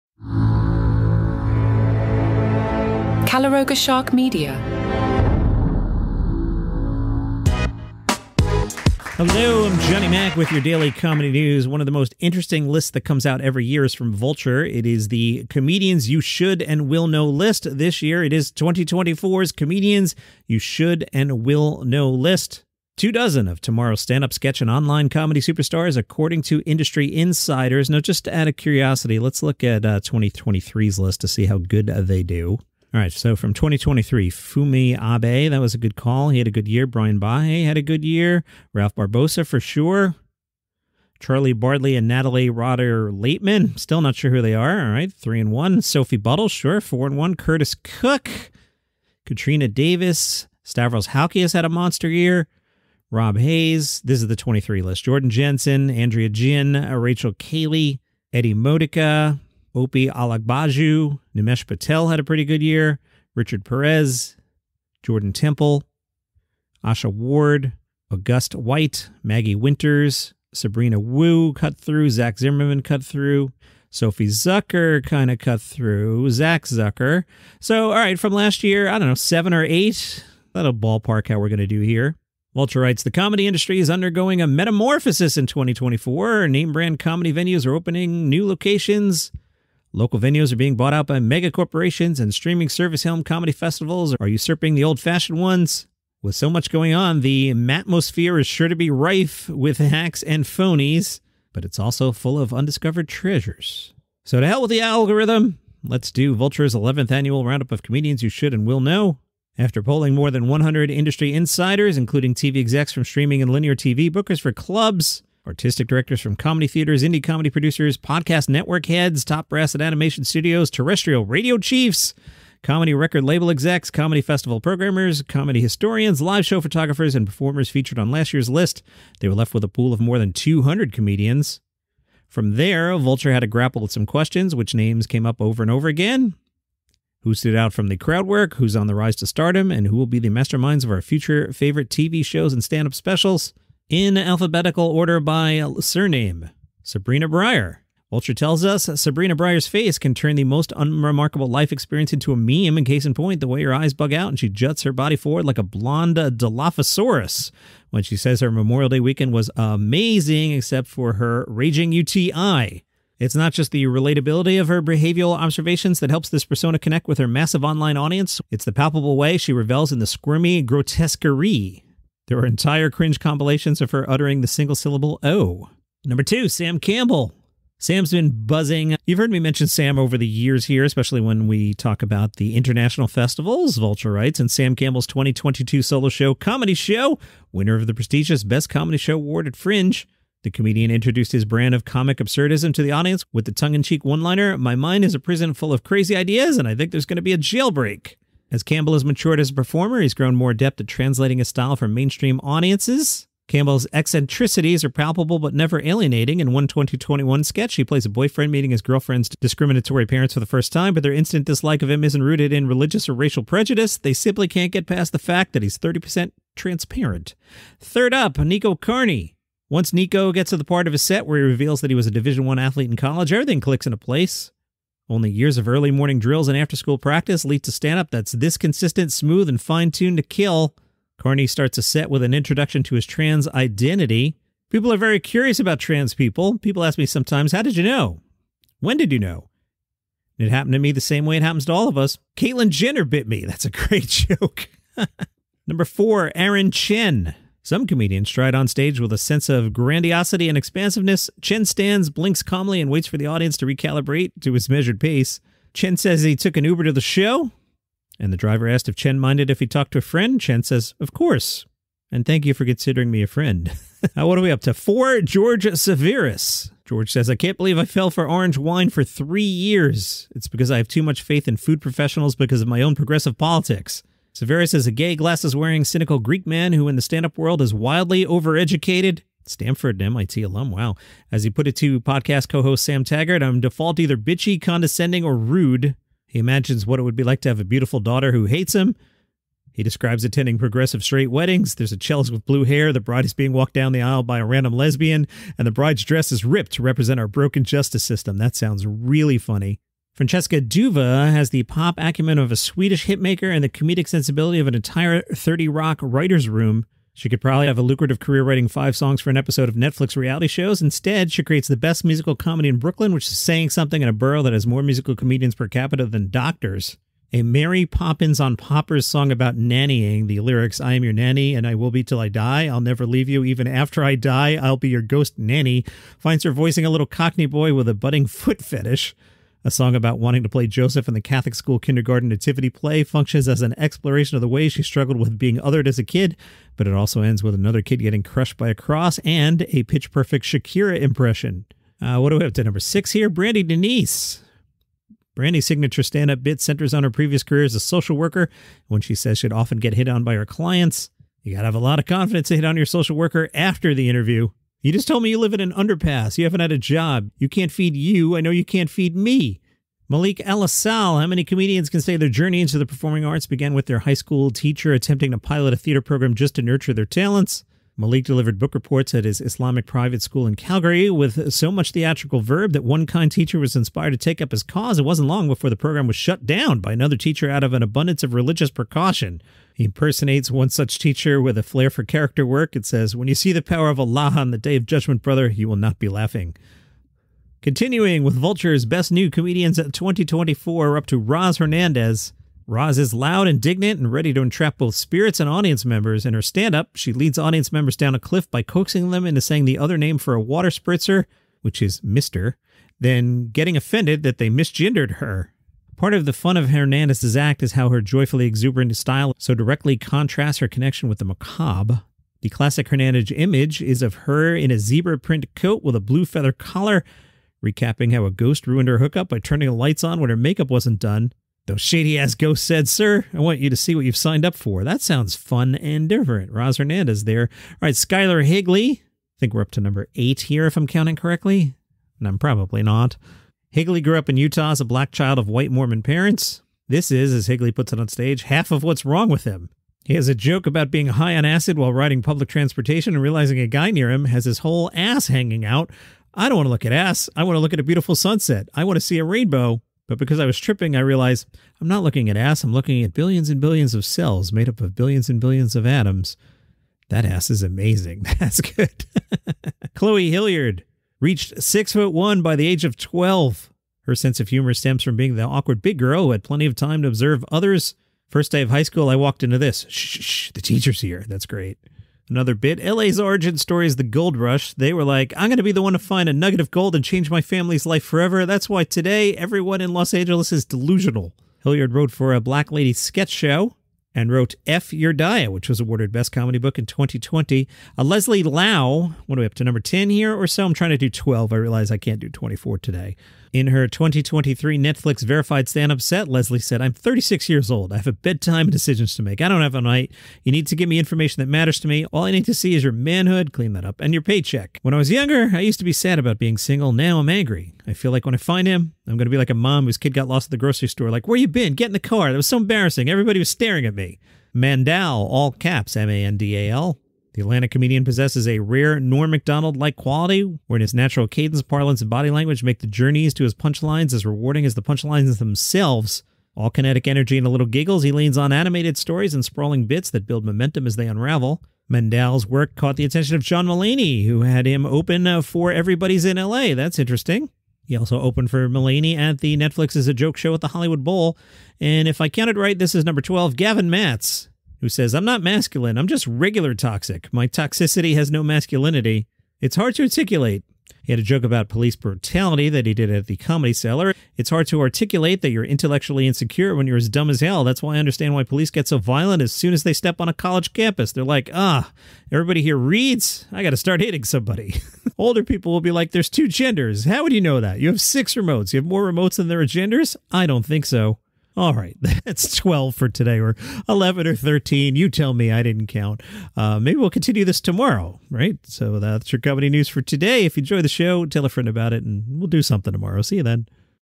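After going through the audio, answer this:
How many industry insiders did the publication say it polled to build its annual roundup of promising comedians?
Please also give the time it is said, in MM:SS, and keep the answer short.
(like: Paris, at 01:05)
more than 100, at 01:50.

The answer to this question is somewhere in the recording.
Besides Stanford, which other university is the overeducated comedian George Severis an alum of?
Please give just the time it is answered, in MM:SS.
04:40.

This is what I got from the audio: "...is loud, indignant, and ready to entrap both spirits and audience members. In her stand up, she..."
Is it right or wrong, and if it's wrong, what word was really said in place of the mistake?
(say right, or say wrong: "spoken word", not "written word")
right.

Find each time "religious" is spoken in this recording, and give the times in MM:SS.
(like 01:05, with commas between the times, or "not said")
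03:32, 06:18.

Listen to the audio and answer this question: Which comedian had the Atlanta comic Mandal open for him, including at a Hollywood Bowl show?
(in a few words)
John Mulaney.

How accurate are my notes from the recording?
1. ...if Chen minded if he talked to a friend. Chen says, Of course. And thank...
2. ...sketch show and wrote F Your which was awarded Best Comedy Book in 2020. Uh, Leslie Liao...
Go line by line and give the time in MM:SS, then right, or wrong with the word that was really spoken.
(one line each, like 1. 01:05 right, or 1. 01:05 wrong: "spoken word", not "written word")
1. 04:18 right
2. 08:02 right.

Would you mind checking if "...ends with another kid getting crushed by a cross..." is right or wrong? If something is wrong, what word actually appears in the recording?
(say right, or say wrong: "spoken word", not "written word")
right.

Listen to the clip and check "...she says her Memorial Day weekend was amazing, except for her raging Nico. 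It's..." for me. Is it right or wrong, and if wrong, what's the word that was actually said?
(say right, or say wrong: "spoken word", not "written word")
wrong: "UTI", not "Nico".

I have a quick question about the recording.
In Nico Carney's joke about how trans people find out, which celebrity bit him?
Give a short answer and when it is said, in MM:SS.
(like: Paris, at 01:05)
Caitlyn Jenner, at 04:02.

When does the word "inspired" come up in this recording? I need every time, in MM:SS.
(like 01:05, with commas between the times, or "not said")
06:13.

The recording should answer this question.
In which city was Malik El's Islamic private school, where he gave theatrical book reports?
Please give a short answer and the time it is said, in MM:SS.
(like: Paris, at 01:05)
Calgary, at 06:10.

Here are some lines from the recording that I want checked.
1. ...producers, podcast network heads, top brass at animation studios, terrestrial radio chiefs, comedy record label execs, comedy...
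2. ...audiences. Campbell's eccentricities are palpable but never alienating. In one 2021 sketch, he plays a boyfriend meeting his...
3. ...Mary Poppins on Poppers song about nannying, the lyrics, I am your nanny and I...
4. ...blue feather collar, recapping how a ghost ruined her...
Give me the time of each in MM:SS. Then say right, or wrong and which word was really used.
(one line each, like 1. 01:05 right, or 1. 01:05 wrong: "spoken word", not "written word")
1. 01:57 right
2. 03:22 right
3. 05:17 right
4. 06:55 right.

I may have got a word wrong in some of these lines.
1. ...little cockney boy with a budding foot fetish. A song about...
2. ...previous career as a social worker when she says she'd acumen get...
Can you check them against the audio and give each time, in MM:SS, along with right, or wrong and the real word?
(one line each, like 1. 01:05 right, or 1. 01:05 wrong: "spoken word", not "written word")
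1. 05:26 right
2. 05:47 wrong: "often", not "acumen".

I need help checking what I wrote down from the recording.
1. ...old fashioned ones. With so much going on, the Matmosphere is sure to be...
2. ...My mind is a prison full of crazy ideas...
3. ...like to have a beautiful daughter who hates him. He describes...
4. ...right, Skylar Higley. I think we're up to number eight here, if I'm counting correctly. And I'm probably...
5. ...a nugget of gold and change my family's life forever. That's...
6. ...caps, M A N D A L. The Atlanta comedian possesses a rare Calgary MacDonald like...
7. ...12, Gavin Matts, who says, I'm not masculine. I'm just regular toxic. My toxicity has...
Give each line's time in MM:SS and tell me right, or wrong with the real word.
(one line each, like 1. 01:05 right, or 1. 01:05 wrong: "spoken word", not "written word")
1. 01:34 right
2. 03:14 right
3. 04:47 right
4. 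07:07 right
5. 07:56 right
6. 08:35 wrong: "Norm", not "Calgary"
7. 09:03 right.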